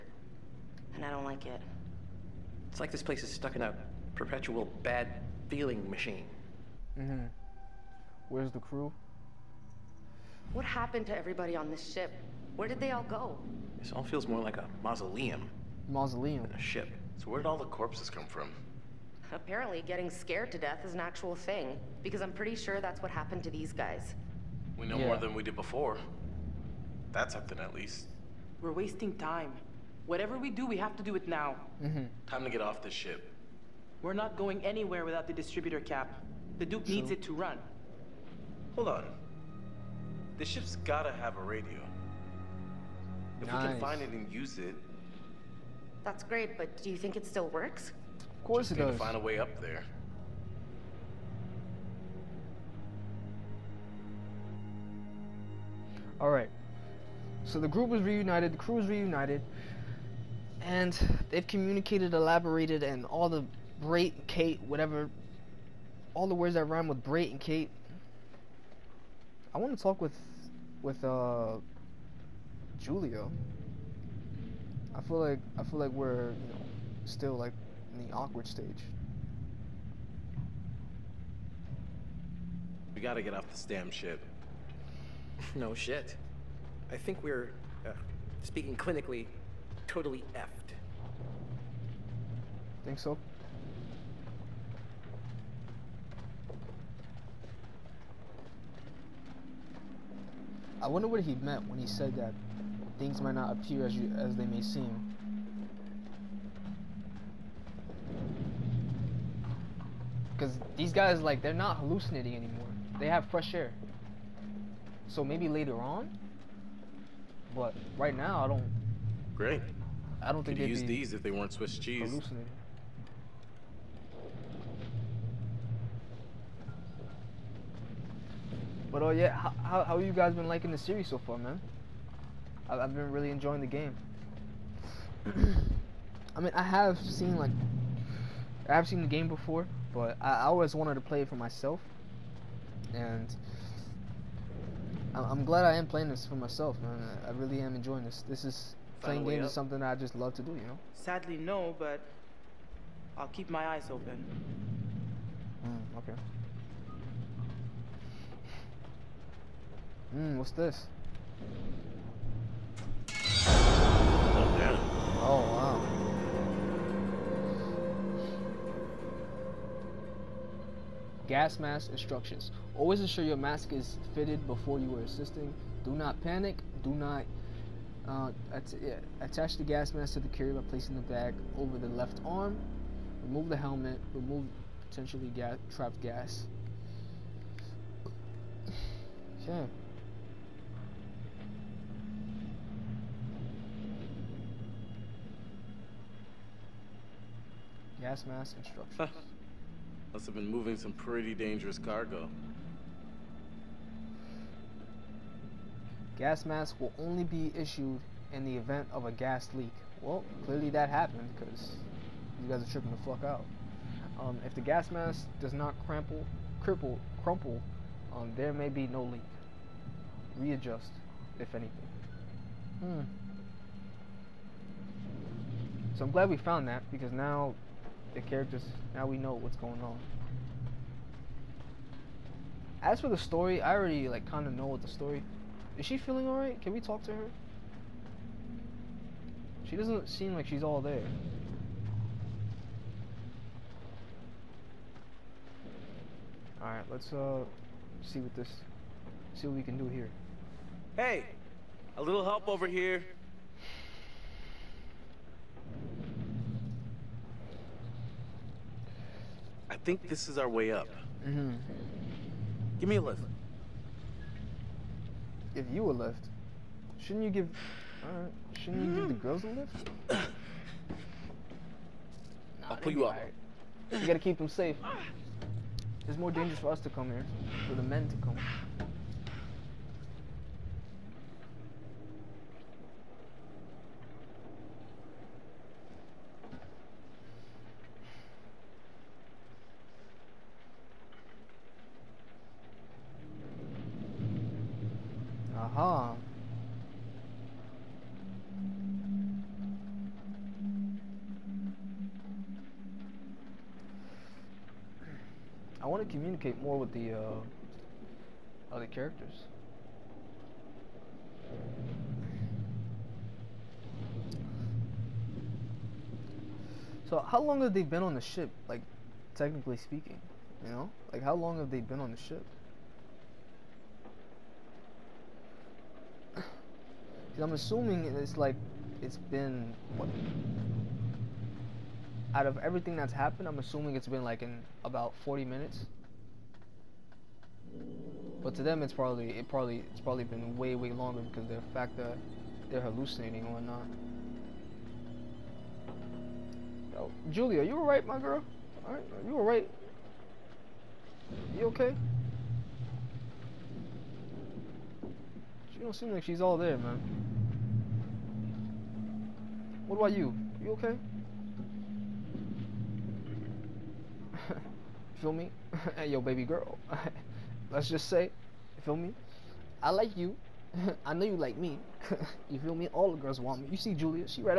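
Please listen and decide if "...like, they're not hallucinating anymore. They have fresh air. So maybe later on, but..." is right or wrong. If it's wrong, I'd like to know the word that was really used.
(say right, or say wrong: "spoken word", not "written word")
right.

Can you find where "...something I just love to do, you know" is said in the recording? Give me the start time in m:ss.
2:29.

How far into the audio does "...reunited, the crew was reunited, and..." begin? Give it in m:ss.
0:58.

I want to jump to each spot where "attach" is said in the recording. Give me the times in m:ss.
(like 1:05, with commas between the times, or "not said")
2:59.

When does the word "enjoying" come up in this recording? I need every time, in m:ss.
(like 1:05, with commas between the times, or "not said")
2:13, 2:27.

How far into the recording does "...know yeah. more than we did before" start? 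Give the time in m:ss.
0:24.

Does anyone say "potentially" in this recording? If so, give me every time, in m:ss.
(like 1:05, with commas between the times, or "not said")
3:04.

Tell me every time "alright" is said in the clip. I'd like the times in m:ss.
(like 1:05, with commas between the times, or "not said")
3:56, 4:06.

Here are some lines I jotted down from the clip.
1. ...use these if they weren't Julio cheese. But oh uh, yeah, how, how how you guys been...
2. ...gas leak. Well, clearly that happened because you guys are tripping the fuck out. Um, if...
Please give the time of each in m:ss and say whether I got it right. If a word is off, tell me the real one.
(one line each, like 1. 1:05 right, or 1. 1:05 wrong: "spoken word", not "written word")
1. 2:00 wrong: "Swiss", not "Julio"
2. 3:29 right.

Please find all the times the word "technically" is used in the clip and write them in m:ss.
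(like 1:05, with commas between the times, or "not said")
5:19.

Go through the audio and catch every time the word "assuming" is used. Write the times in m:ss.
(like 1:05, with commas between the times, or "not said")
5:27, 5:33.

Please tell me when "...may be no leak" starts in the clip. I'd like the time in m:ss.
3:38.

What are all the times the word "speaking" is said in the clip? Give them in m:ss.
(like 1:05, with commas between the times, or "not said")
1:28, 5:19.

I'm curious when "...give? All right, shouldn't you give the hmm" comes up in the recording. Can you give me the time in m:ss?
4:27.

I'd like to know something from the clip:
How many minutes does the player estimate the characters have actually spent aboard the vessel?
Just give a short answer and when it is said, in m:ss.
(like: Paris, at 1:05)
40, at 5:35.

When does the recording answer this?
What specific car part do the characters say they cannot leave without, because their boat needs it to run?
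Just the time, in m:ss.
0:35.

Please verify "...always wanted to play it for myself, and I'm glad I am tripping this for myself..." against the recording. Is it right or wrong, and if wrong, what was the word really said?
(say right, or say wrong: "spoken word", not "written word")
wrong: "playing", not "tripping".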